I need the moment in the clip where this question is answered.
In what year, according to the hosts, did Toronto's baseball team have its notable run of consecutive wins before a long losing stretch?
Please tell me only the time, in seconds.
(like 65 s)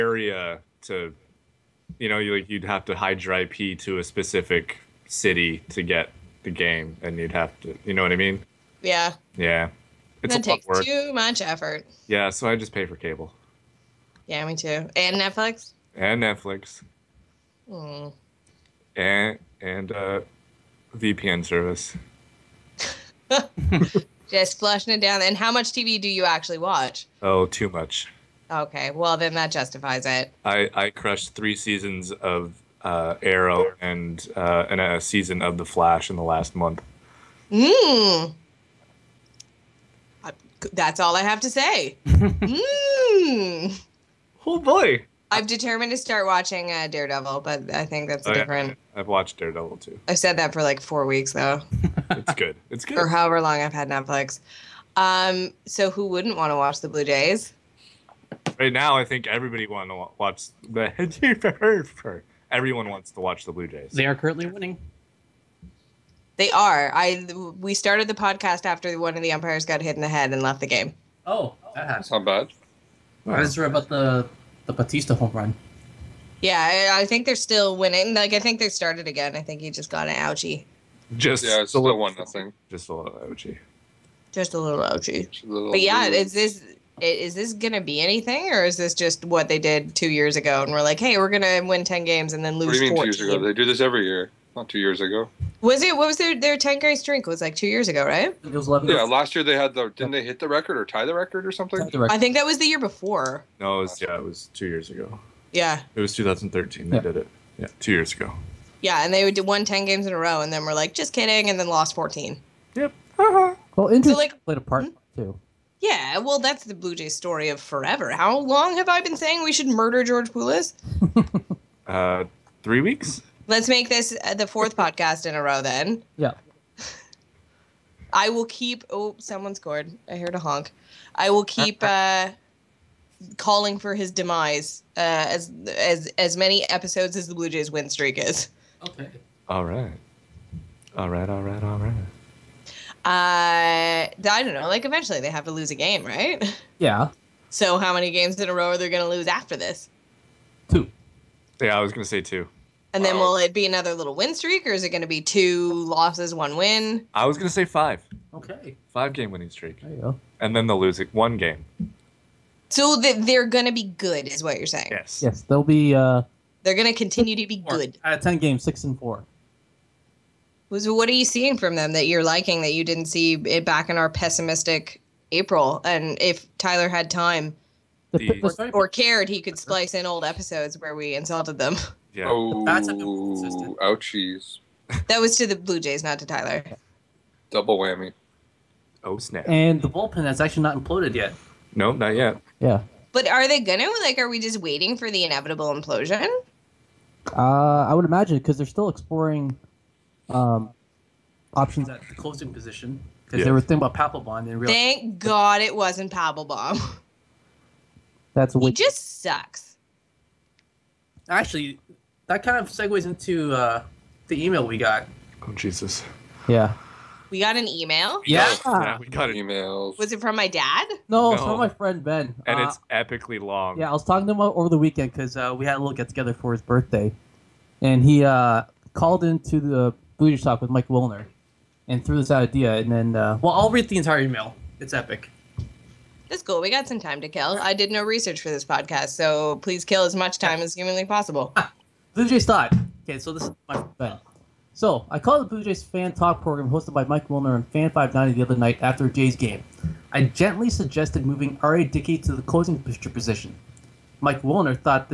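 106 s.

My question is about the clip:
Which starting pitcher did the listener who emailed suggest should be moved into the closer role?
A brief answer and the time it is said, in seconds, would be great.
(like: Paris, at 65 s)
R.A. Dickey, at 251 s.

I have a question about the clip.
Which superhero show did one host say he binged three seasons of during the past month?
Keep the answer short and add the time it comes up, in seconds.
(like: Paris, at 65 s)
Arrow, at 33 s.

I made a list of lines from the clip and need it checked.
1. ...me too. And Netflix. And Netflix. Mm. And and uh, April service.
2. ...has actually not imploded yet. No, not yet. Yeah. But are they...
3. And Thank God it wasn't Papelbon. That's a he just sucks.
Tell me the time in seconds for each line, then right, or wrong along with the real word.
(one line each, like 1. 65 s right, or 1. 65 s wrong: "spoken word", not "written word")
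1. 14 s wrong: "VPN", not "April"
2. 190 s right
3. 204 s right.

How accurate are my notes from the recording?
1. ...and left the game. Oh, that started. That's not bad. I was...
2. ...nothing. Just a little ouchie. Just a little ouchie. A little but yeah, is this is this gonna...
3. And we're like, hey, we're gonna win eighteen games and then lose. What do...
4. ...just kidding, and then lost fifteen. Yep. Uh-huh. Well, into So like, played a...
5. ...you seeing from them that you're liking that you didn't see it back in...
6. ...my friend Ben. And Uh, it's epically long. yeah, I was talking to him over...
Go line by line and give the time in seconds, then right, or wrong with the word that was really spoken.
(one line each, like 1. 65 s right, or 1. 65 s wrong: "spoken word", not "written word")
1. 70 s wrong: "happened", not "started"
2. 82 s right
3. 90 s wrong: "ten", not "eighteen"
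4. 110 s wrong: "fourteen", not "fifteen"
5. 171 s right
6. 221 s right.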